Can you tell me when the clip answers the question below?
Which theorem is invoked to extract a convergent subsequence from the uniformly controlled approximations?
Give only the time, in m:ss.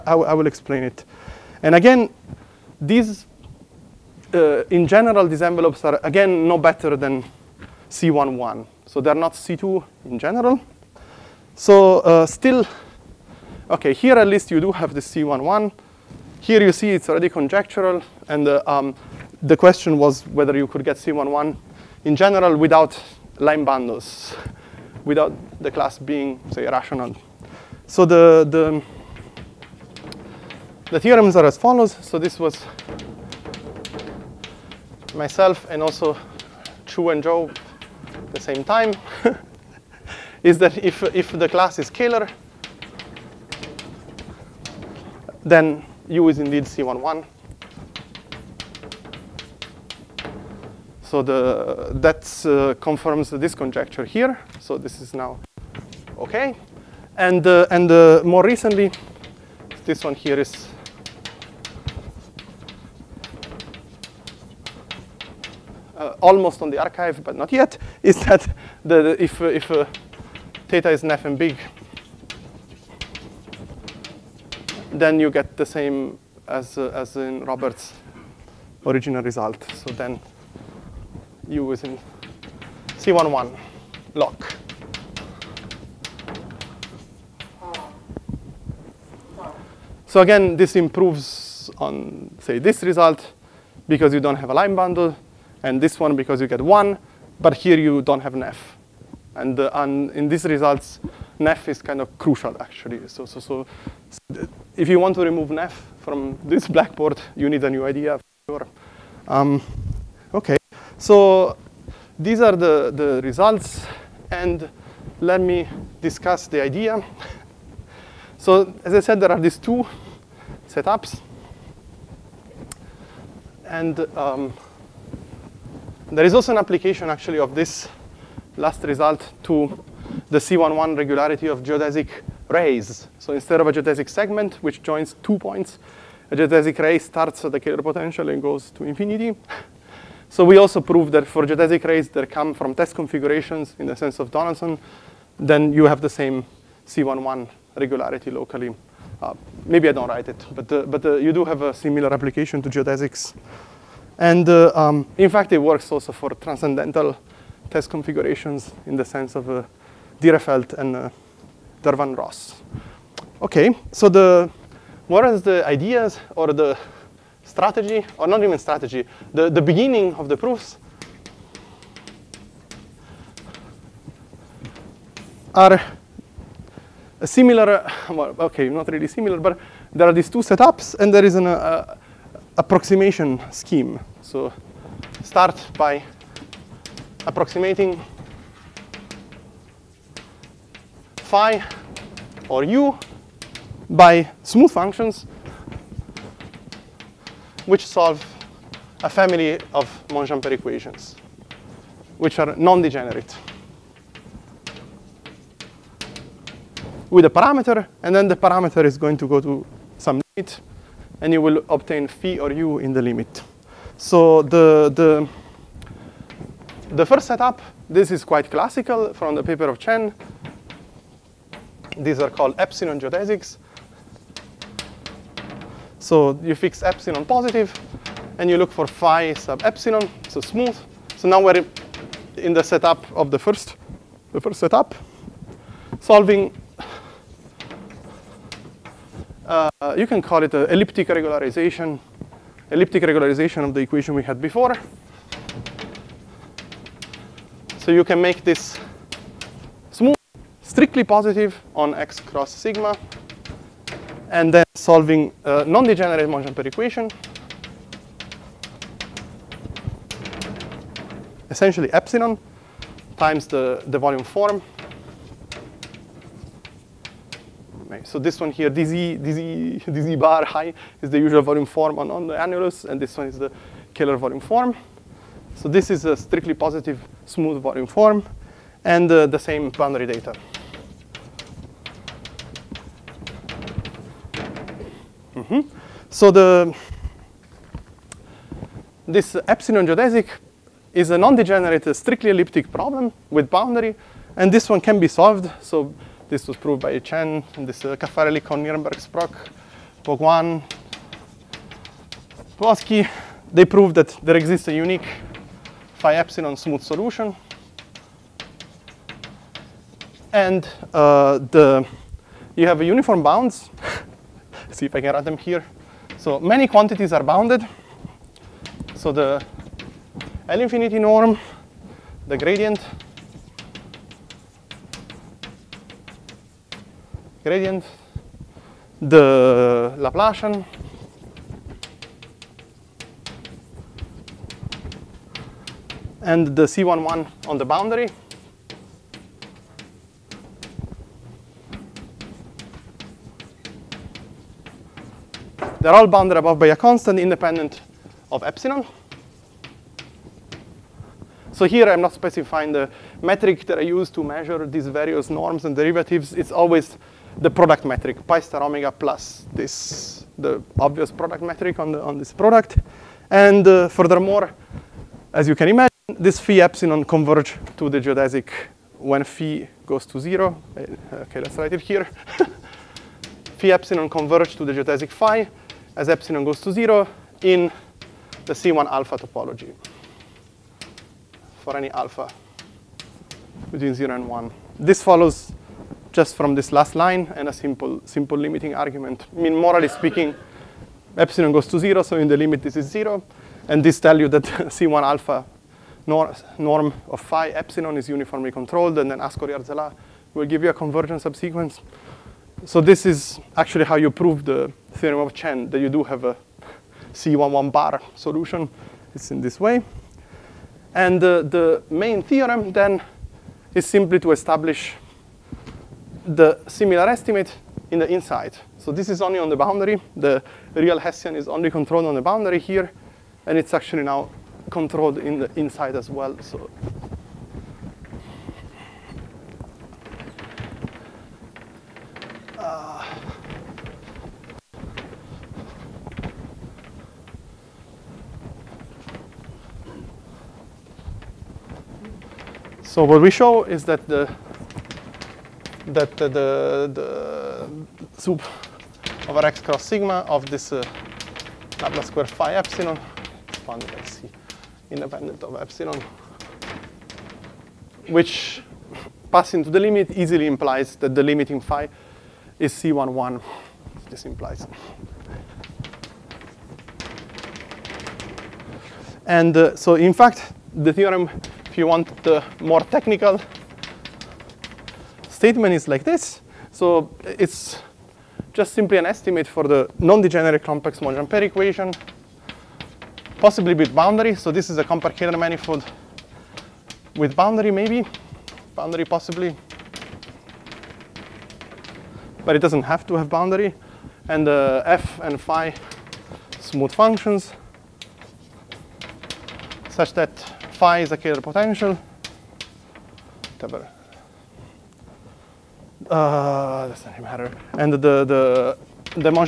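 6:39.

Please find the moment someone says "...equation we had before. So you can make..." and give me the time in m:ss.
4:03.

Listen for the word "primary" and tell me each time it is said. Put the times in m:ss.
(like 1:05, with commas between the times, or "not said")
not said.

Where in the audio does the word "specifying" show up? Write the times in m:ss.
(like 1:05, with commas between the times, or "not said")
5:52.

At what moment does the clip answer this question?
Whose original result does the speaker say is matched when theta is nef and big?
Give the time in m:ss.
1:17.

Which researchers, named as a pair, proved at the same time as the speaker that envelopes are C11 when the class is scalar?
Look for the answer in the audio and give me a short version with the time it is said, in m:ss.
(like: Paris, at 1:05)
Chu and Zhou, at 0:36.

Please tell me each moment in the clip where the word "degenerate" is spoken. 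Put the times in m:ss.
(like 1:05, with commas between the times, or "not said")
3:22, 4:15, 4:51, 8:00.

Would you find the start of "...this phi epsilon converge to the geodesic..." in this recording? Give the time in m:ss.
6:06.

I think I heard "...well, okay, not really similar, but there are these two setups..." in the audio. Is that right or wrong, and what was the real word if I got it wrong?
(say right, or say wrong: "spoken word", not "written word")
right.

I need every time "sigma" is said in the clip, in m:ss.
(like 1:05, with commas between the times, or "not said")
4:12, 7:29.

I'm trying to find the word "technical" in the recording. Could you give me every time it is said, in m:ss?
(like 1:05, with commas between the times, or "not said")
7:52.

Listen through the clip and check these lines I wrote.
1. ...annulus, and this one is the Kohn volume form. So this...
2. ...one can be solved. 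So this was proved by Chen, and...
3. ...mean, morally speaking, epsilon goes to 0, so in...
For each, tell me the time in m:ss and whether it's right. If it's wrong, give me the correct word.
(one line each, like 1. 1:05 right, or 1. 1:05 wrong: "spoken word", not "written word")
1. 4:32 wrong: "Kähler", not "Kohn"
2. 4:54 right
3. 6:29 right.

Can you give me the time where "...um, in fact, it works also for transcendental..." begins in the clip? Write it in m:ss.
2:34.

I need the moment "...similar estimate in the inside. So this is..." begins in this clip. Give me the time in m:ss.
6:56.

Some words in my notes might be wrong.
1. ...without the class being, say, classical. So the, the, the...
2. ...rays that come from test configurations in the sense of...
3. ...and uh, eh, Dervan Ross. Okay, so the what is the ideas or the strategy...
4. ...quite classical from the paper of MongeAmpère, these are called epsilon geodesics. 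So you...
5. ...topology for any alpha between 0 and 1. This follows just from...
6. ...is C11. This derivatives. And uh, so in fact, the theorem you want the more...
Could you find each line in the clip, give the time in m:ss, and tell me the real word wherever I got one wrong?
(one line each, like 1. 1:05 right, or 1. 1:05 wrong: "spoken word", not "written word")
1. 0:25 wrong: "rational", not "classical"
2. 2:21 right
3. 2:40 right
4. 3:38 wrong: "Chen", not "MongeAmpère"
5. 6:19 right
6. 7:42 wrong: "implies", not "derivatives".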